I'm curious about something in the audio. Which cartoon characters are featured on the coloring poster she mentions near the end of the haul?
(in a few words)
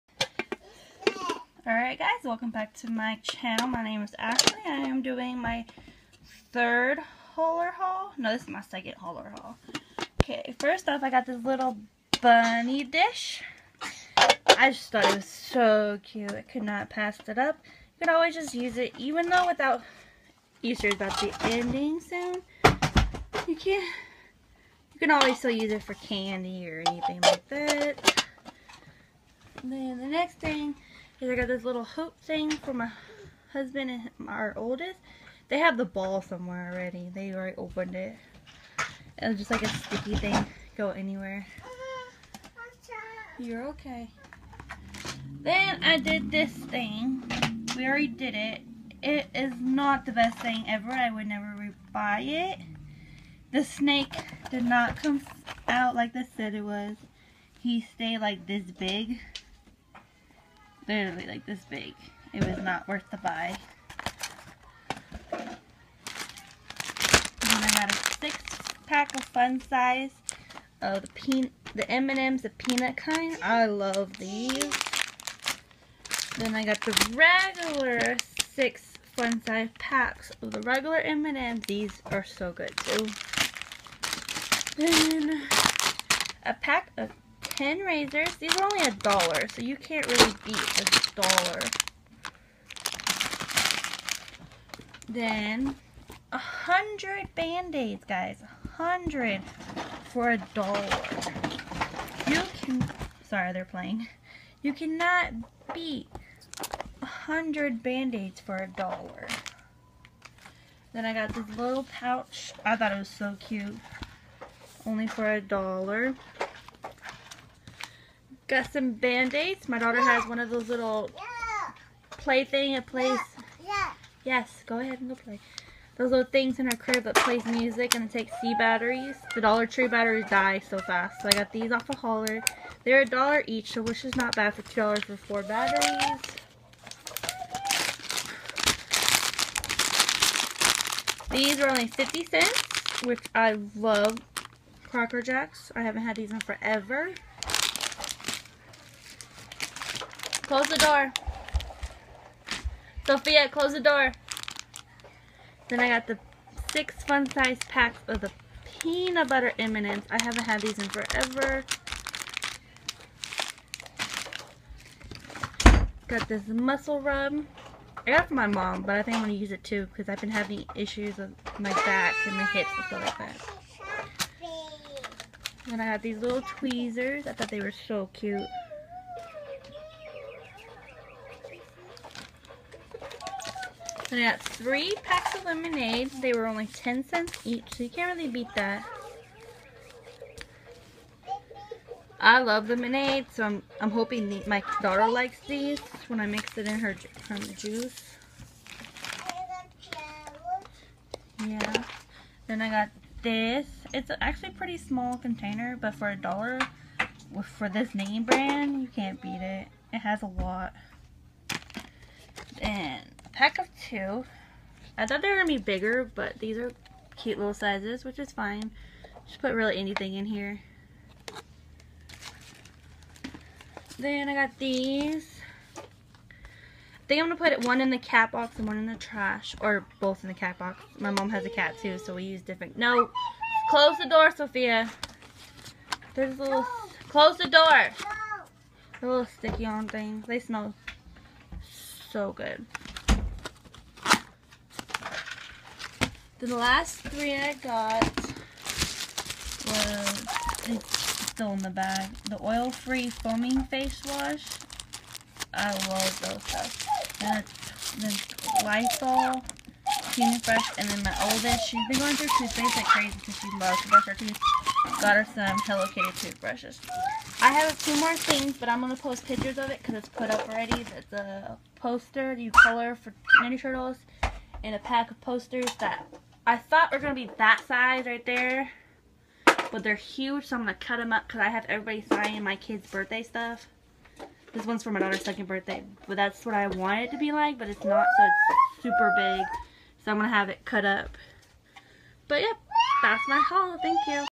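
Ninja Turtles.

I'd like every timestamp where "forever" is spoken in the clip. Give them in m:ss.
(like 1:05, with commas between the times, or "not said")
2:26, 2:40.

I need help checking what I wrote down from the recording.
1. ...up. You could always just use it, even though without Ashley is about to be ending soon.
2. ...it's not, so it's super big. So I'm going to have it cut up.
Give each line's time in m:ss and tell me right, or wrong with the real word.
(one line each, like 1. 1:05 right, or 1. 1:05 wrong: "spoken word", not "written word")
1. 0:17 wrong: "Easter", not "Ashley"
2. 4:47 right.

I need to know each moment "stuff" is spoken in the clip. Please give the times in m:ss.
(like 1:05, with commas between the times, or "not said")
2:52, 4:43.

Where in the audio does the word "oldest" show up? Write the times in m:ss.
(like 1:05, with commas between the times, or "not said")
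0:34, 4:21.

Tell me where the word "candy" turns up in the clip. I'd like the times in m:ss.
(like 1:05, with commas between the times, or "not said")
0:25.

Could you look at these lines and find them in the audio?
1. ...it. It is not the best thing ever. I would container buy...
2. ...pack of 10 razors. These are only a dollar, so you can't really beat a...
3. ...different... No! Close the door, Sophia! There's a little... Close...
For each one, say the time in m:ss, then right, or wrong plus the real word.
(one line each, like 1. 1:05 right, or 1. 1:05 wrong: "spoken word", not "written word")
1. 0:48 wrong: "never", not "container"
2. 1:26 right
3. 3:52 right.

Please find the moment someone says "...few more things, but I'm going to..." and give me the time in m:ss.
4:27.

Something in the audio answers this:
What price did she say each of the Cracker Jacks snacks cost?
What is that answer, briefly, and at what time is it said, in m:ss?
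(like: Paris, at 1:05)
50 cents, at 2:21.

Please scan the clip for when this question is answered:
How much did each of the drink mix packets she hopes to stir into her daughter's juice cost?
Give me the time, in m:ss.
3:06.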